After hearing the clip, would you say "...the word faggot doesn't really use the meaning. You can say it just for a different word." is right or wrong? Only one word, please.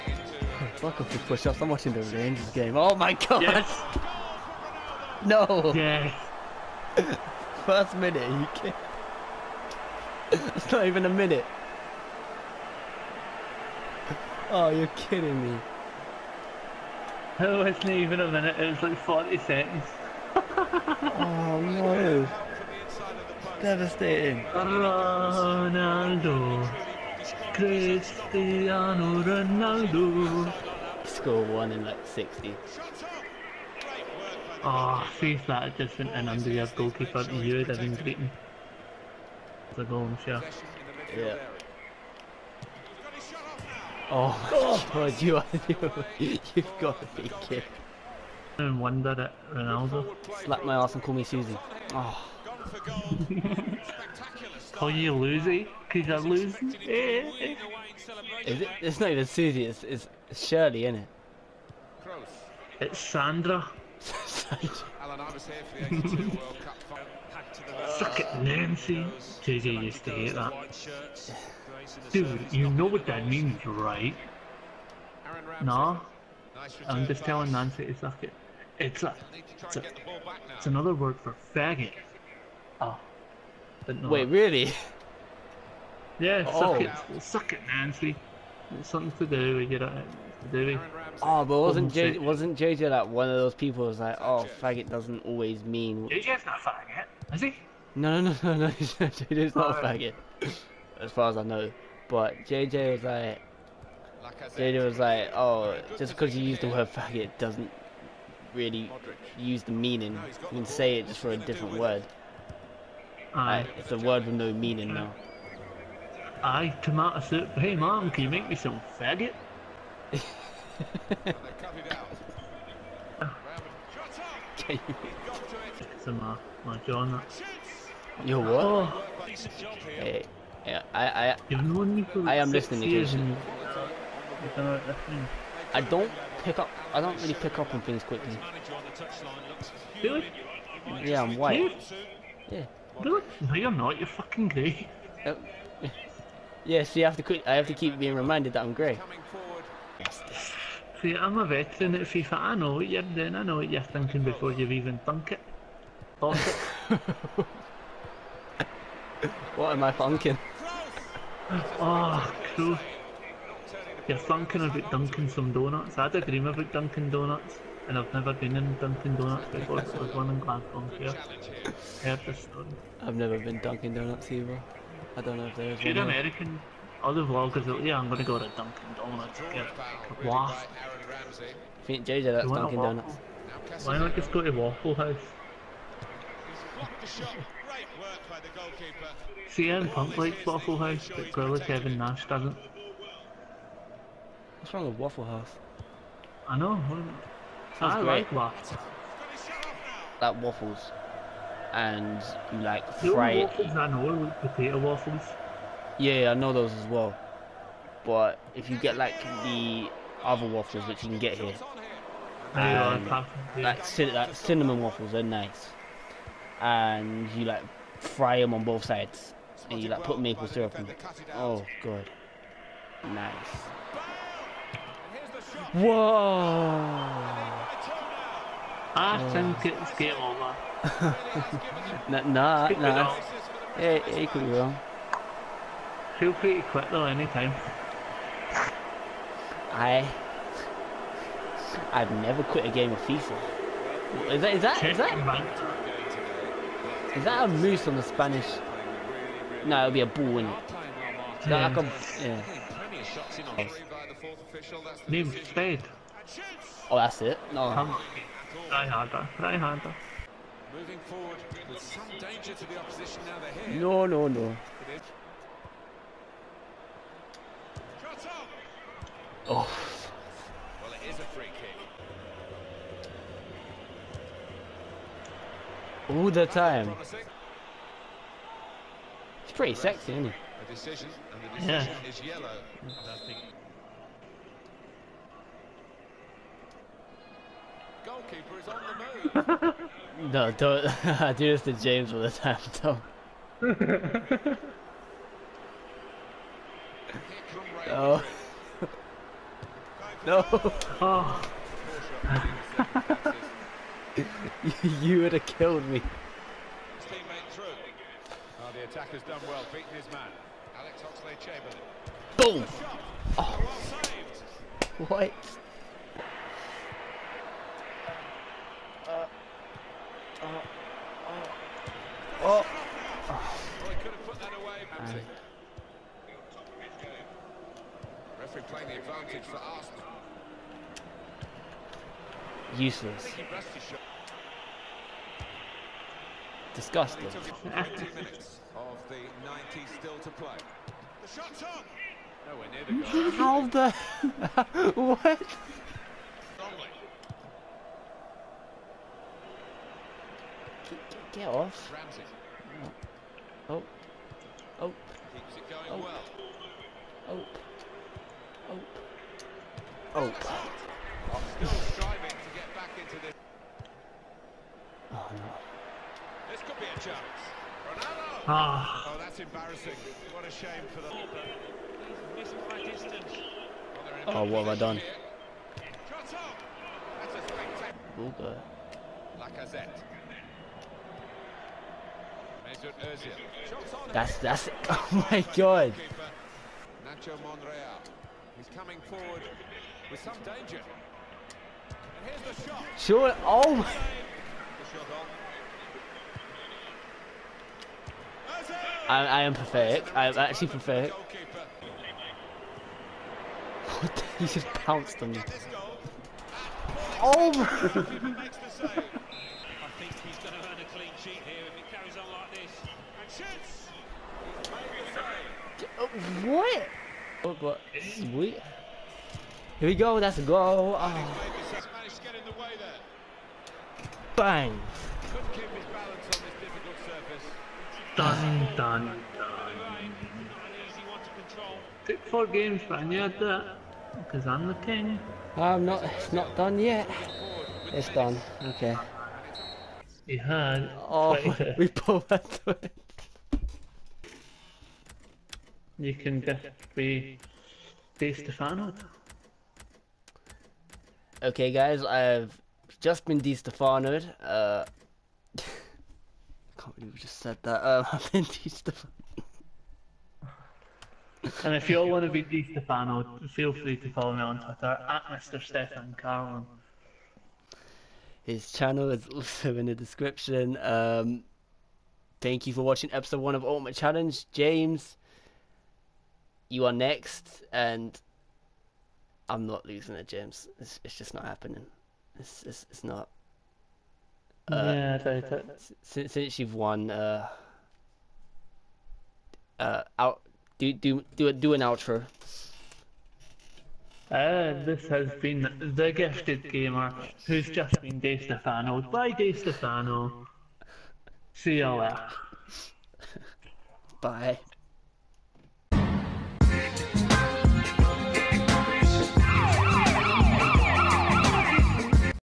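right.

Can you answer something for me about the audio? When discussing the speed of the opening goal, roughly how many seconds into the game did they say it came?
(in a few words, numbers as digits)
40.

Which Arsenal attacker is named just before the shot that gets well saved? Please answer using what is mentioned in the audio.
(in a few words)
Alex Oxlade-Chamberlain.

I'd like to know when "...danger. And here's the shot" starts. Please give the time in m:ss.
6:30.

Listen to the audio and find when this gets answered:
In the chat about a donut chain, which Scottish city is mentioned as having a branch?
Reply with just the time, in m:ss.
2:50.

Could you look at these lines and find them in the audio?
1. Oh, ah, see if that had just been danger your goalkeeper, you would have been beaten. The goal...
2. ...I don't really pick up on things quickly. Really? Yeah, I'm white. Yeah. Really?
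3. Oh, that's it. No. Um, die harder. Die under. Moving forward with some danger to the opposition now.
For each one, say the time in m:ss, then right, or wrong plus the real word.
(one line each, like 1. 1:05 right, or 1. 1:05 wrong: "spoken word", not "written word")
1. 0:32 wrong: "under", not "danger"
2. 2:16 right
3. 4:16 wrong: "harder", not "under".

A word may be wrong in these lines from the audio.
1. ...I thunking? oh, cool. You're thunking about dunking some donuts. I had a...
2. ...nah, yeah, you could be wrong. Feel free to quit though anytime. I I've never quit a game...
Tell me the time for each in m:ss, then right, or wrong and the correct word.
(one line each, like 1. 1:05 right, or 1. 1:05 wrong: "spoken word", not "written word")
1. 2:39 right
2. 3:52 right.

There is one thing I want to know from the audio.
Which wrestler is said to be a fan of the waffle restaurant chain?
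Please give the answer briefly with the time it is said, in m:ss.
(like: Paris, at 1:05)
CM Punk, at 3:09.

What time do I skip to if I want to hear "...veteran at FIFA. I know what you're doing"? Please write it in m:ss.
2:31.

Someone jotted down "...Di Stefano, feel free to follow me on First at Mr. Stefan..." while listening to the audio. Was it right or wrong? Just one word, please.
wrong.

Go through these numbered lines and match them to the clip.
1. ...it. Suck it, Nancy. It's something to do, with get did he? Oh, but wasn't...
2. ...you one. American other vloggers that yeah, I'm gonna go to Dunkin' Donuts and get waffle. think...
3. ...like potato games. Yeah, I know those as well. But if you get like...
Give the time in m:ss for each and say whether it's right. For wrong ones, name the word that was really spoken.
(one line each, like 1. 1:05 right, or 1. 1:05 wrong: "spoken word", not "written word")
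1. 1:26 right
2. 2:55 right
3. 3:24 wrong: "waffles", not "games".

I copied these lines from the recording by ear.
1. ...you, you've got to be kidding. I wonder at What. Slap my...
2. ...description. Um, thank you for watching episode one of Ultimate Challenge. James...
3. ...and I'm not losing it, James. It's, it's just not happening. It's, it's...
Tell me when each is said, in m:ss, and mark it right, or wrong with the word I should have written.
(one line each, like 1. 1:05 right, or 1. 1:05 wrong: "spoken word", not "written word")
1. 0:46 wrong: "Ronaldo", not "What"
2. 7:49 right
3. 7:57 right.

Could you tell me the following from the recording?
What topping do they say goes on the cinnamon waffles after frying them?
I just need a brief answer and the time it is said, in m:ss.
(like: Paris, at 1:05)
maple syrup, at 3:40.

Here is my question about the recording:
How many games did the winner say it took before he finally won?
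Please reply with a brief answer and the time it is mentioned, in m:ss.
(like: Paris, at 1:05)
4, at 7:12.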